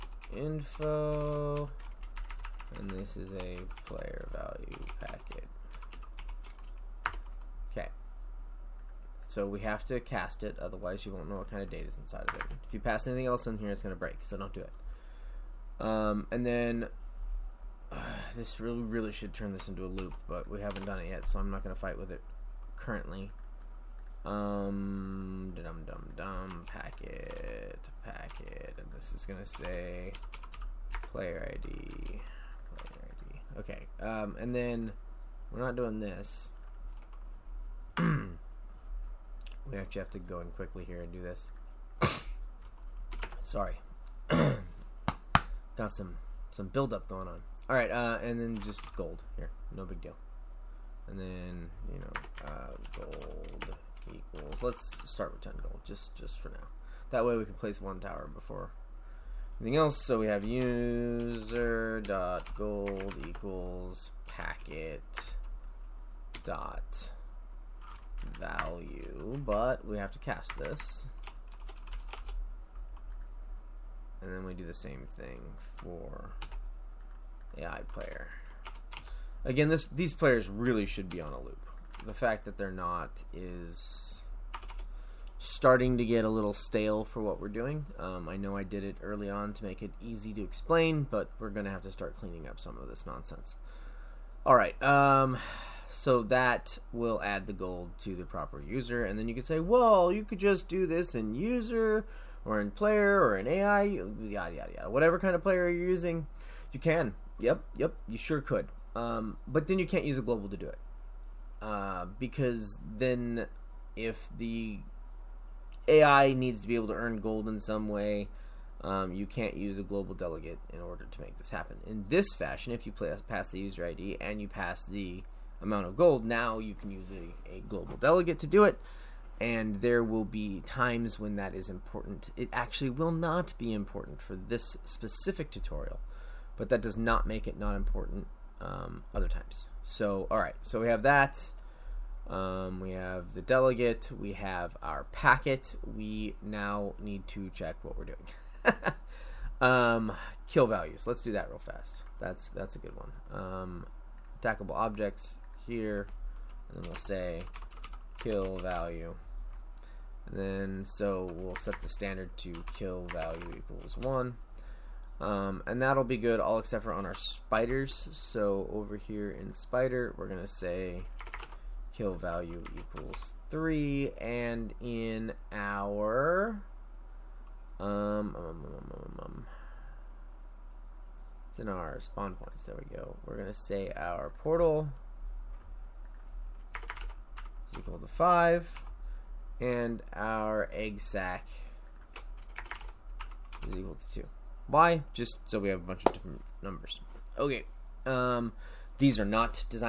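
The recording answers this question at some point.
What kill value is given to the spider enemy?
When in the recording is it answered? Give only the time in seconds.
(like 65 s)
173 s.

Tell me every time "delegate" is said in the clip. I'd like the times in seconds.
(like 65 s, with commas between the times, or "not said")
120 s, 127 s, 143 s.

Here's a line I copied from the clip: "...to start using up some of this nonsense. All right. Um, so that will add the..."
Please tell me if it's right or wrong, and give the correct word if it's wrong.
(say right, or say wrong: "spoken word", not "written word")
wrong: "cleaning", not "using".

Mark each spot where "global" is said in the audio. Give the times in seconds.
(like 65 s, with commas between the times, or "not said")
110 s, 119 s, 127 s.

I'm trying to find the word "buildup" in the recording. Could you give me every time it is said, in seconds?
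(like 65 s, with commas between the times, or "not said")
46 s.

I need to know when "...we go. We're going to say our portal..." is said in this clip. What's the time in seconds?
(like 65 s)
182 s.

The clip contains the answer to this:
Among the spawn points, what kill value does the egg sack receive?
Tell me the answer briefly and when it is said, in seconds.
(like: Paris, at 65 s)
2, at 194 s.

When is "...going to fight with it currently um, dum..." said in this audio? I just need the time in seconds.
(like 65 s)
21 s.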